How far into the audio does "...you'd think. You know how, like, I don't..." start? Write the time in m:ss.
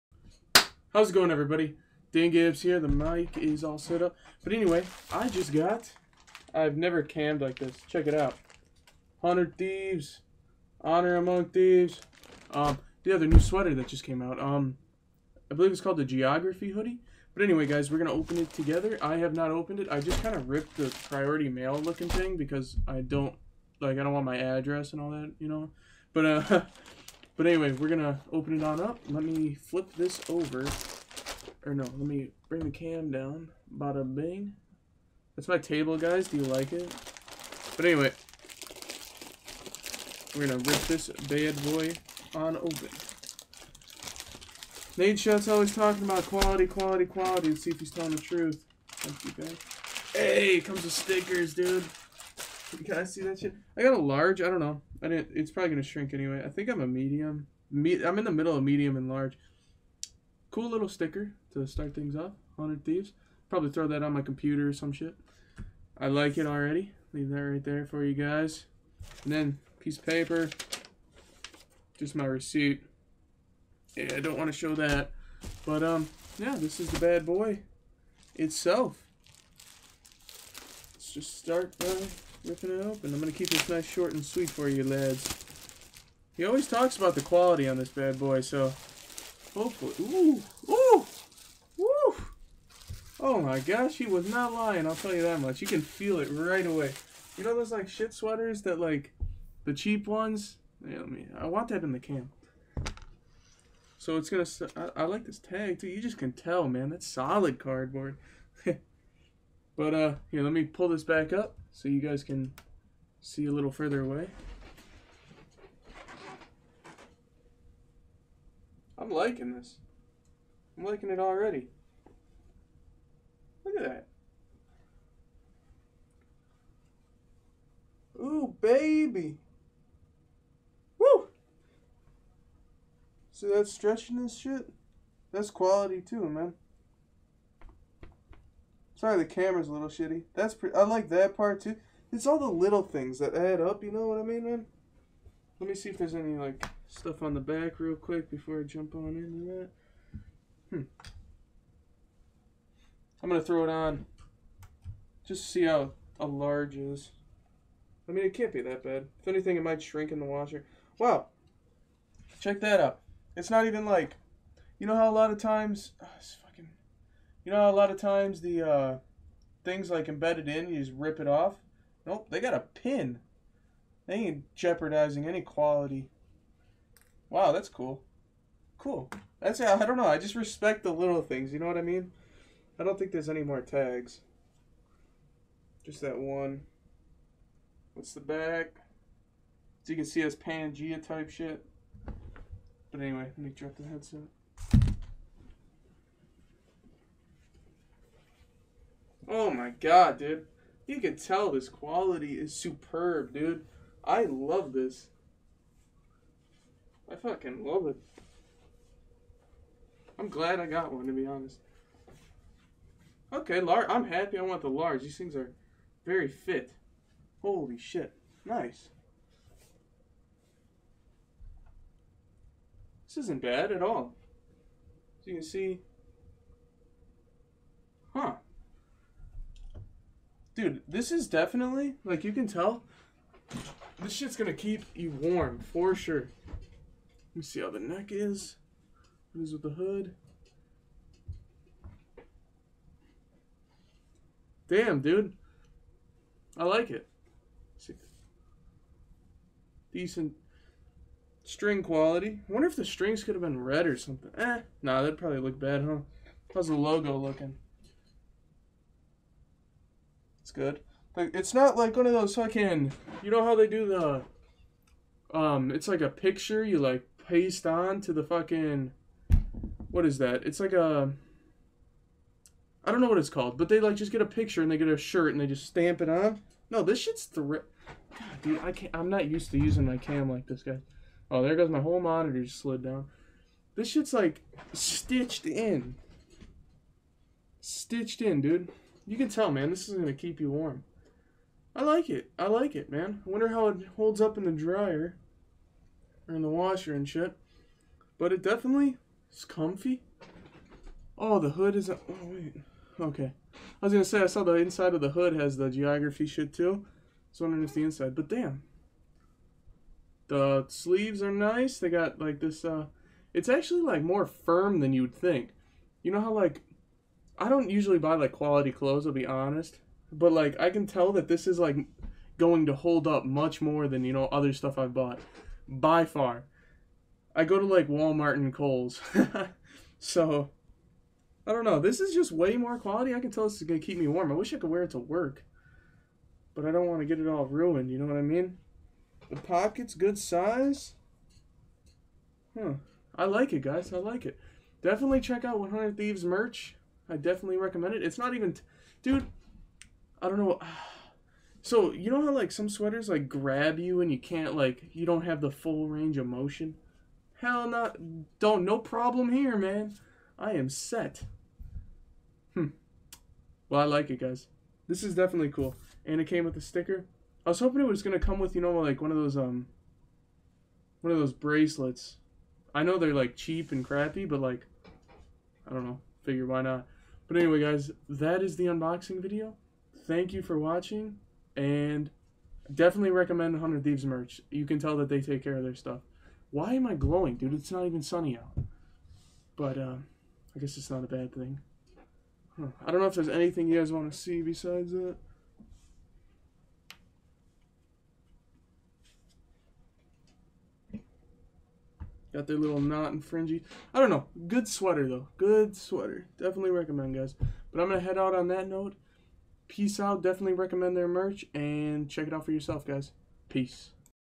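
5:14.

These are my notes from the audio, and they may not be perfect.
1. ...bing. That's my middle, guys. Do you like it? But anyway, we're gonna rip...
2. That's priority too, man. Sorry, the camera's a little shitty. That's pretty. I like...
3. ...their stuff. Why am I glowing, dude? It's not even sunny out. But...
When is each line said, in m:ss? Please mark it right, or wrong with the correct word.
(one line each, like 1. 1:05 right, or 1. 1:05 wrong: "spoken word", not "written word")
1. 0:34 wrong: "table", not "middle"
2. 2:15 wrong: "quality", not "priority"
3. 6:25 right.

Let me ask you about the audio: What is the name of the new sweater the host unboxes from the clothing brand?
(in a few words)
Geography Hoodie.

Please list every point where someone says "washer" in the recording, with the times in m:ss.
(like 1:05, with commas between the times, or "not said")
2:40, 4:56.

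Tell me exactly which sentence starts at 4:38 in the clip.
I'm not used to using my cam like this, guys.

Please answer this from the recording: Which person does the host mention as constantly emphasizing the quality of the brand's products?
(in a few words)
Nadeshot.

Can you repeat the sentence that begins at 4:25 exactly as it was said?
Um, it's like a picture you like paste on to the fucking.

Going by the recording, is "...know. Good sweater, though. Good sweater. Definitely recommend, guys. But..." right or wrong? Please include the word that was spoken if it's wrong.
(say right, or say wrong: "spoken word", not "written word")
right.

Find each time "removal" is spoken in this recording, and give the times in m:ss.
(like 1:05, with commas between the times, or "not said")
not said.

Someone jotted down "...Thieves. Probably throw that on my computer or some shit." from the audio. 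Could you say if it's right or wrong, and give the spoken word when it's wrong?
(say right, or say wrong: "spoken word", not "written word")
right.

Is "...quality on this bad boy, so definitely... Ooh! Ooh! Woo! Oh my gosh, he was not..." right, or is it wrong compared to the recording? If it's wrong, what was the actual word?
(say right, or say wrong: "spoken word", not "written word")
wrong: "hopefully", not "definitely".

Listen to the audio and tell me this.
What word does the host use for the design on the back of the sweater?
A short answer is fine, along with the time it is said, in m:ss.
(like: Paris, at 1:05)
Pangea, at 3:10.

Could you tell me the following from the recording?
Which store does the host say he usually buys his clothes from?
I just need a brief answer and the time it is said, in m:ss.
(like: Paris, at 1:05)
Walmart, at 5:27.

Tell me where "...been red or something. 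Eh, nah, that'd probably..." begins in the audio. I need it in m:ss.
4:13.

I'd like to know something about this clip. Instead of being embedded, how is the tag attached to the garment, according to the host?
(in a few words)
A pin.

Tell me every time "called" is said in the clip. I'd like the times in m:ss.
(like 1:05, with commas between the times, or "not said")
0:15, 4:33.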